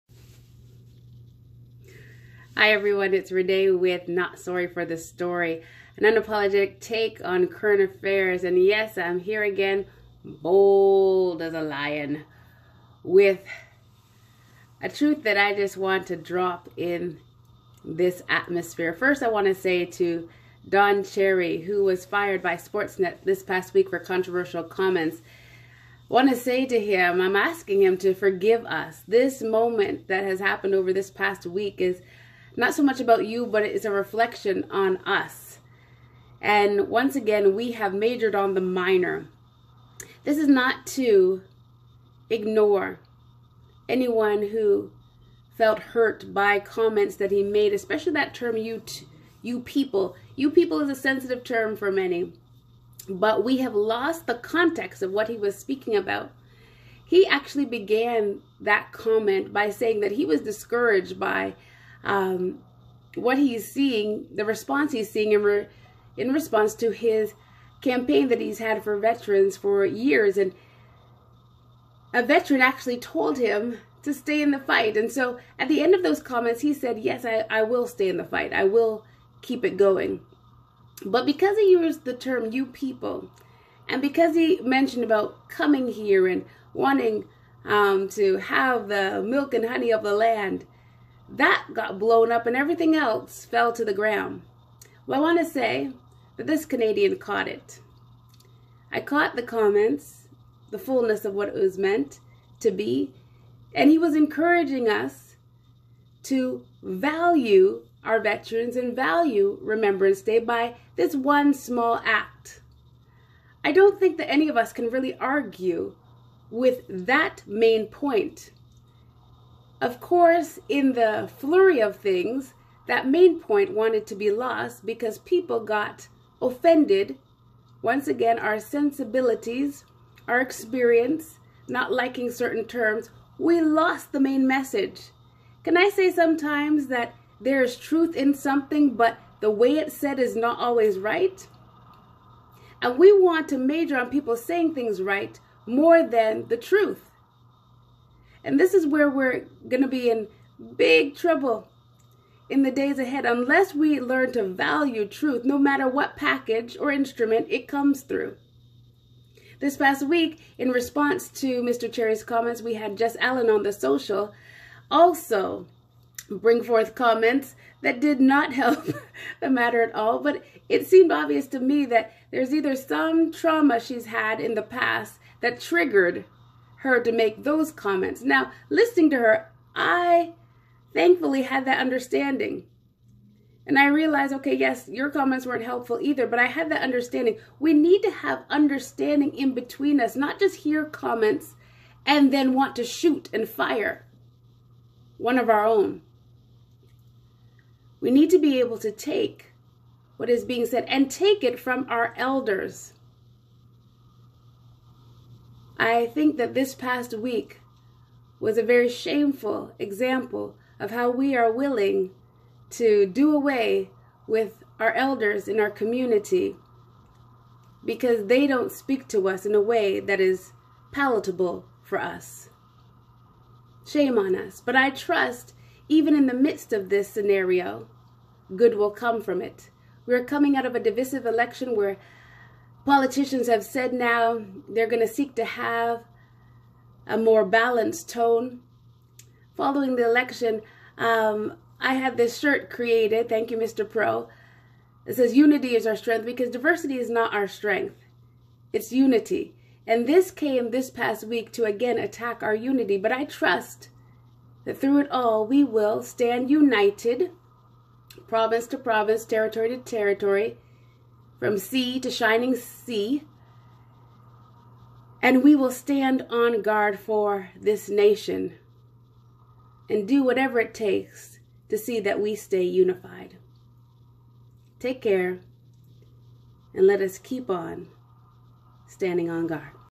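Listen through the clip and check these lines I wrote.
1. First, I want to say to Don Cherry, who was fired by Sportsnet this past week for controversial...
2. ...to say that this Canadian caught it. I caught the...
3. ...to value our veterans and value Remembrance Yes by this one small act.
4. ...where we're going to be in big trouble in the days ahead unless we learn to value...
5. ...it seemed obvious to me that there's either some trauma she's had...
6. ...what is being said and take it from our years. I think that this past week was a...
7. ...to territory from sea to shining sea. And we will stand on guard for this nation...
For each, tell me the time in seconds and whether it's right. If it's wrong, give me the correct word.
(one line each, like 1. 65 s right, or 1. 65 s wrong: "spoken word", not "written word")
1. 18 s right
2. 95 s right
3. 106 s wrong: "Day", not "Yes"
4. 148 s right
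5. 170 s right
6. 200 s wrong: "elders", not "years"
7. 259 s right.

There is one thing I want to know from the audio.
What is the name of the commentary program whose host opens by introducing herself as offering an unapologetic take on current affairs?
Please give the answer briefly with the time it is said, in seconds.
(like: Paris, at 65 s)
Not Sorry for the Story, at 4 s.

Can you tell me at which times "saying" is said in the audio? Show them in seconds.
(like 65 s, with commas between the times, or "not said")
59 s, 144 s.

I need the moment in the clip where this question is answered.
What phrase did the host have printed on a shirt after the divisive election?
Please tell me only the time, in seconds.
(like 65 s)
245 s.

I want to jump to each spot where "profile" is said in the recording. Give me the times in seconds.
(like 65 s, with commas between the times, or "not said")
not said.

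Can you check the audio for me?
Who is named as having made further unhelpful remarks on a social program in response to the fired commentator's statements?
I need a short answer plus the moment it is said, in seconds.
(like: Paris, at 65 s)
Jess Allen, at 162 s.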